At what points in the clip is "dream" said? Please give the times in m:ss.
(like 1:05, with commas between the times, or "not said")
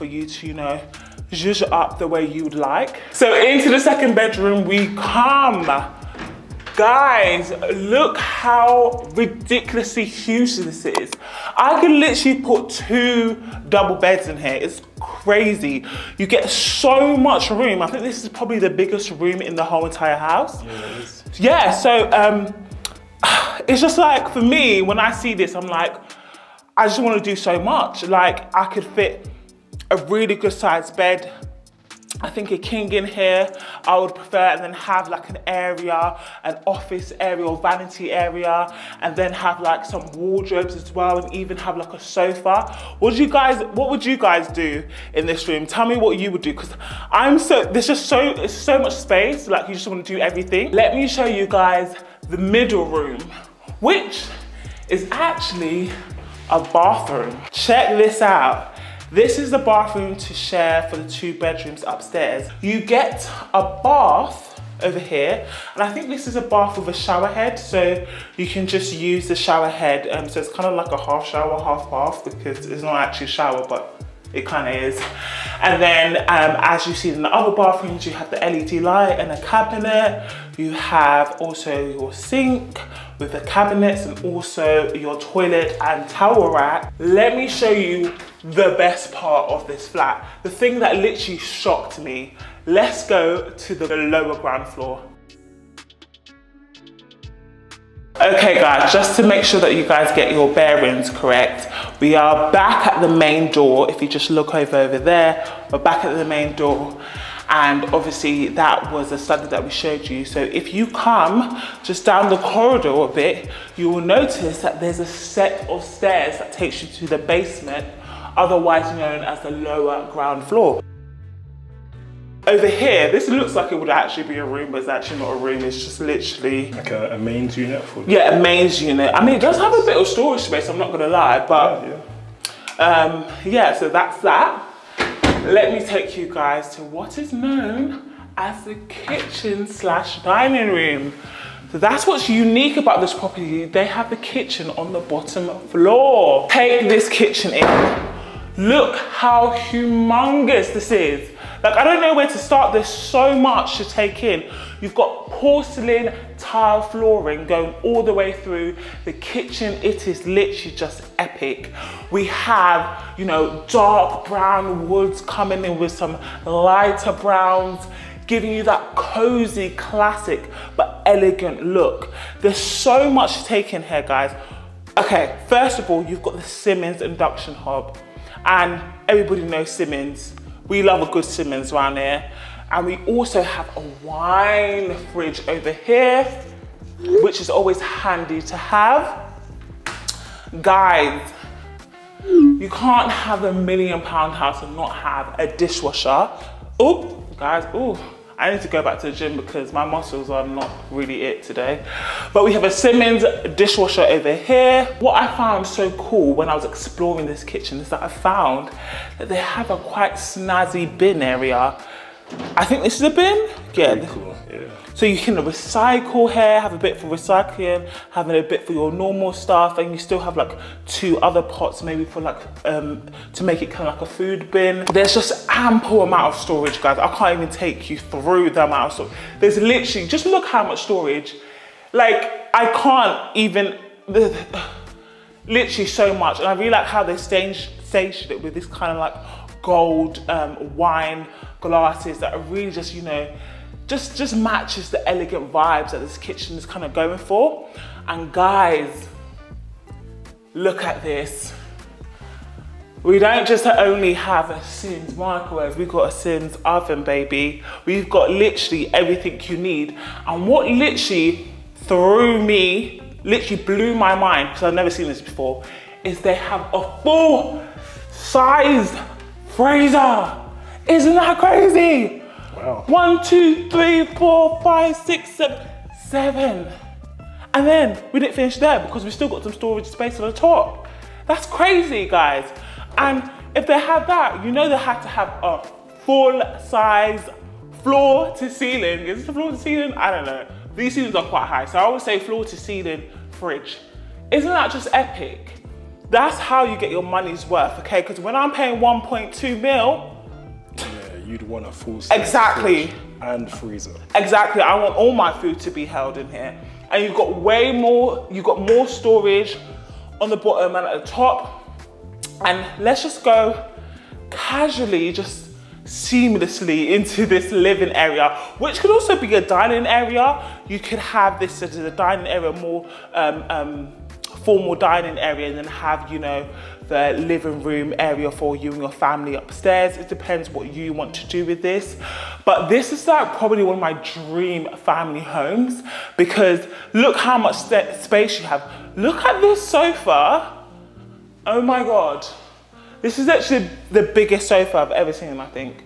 5:33.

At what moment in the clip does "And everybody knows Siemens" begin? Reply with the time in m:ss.
2:58.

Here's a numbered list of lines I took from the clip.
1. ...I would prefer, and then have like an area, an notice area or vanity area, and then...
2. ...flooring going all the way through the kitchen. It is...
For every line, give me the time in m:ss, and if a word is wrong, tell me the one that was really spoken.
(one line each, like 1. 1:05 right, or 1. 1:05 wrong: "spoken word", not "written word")
1. 0:33 wrong: "office", not "notice"
2. 2:36 right.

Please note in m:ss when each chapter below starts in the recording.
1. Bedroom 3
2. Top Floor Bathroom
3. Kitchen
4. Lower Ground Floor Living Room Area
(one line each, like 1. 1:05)
1. 0:05
2. 0:55
3. 2:18
4. 5:11.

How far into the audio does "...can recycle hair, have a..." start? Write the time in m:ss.
3:35.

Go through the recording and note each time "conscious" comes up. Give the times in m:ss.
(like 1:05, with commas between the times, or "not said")
not said.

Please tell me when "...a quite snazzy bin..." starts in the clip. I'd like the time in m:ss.
3:29.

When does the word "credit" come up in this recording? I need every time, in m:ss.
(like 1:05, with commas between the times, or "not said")
not said.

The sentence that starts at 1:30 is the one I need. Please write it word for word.
The thing that literally shocked me.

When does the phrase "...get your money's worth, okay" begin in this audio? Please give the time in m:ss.
4:56.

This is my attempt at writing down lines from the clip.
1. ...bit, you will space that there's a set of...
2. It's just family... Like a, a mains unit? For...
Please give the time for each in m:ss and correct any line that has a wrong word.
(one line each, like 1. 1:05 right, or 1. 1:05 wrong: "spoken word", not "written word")
1. 1:53 wrong: "notice", not "space"
2. 2:05 wrong: "literally", not "family".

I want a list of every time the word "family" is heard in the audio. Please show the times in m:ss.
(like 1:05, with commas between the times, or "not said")
5:28, 5:34.